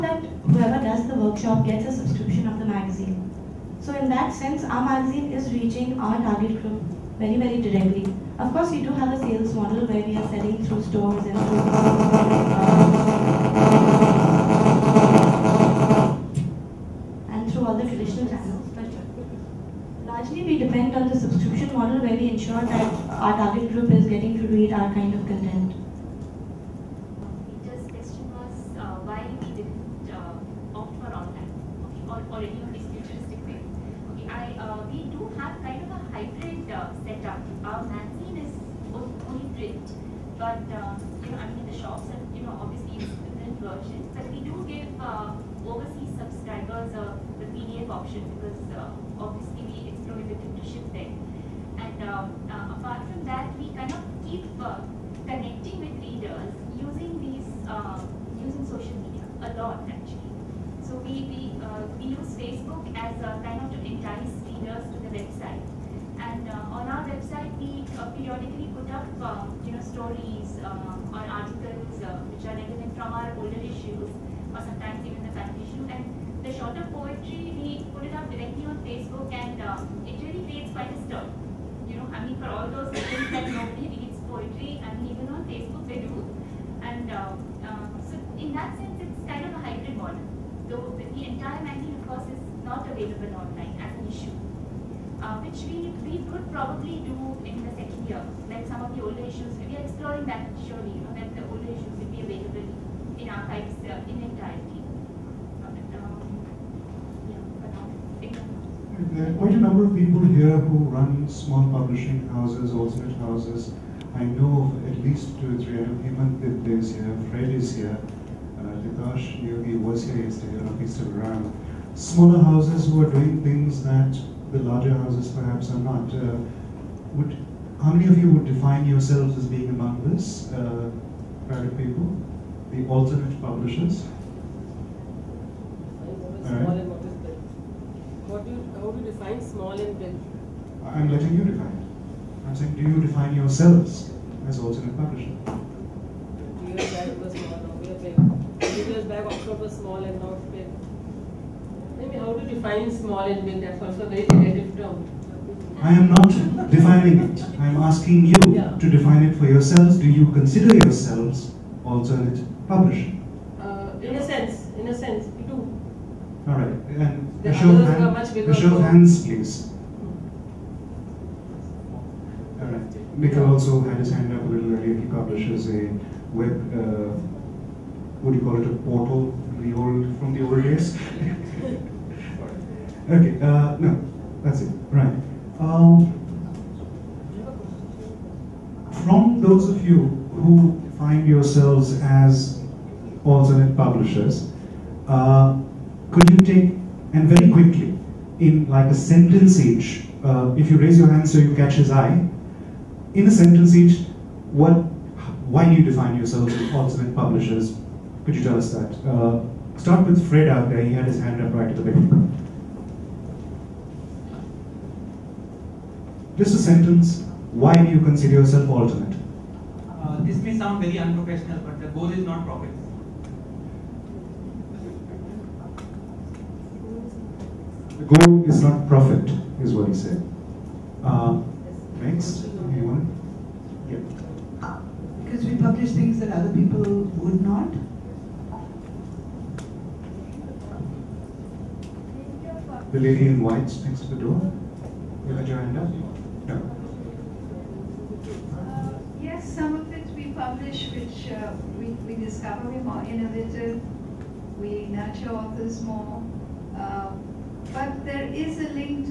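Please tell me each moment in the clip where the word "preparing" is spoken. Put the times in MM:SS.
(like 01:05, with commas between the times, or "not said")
not said.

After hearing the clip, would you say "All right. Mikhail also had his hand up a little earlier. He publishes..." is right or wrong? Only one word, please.
right.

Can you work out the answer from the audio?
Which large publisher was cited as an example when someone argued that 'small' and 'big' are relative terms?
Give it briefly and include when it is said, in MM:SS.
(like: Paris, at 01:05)
Oxford, at 02:29.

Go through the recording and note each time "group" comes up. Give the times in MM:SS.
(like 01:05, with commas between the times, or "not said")
00:06, 00:23.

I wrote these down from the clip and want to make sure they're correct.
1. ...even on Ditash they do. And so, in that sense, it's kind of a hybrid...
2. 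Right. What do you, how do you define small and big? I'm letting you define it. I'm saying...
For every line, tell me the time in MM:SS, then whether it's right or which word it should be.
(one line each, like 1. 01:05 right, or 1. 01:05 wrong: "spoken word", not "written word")
1. 01:25 wrong: "Facebook", not "Ditash"
2. 02:16 right.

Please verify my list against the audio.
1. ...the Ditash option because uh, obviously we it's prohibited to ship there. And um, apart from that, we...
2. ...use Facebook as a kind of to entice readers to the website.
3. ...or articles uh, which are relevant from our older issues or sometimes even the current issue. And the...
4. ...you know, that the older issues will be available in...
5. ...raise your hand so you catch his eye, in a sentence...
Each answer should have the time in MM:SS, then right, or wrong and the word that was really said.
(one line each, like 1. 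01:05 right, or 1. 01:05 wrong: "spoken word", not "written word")
1. 00:47 wrong: "PDF", not "Ditash"
2. 01:02 right
3. 01:11 right
4. 01:40 right
5. 03:20 right.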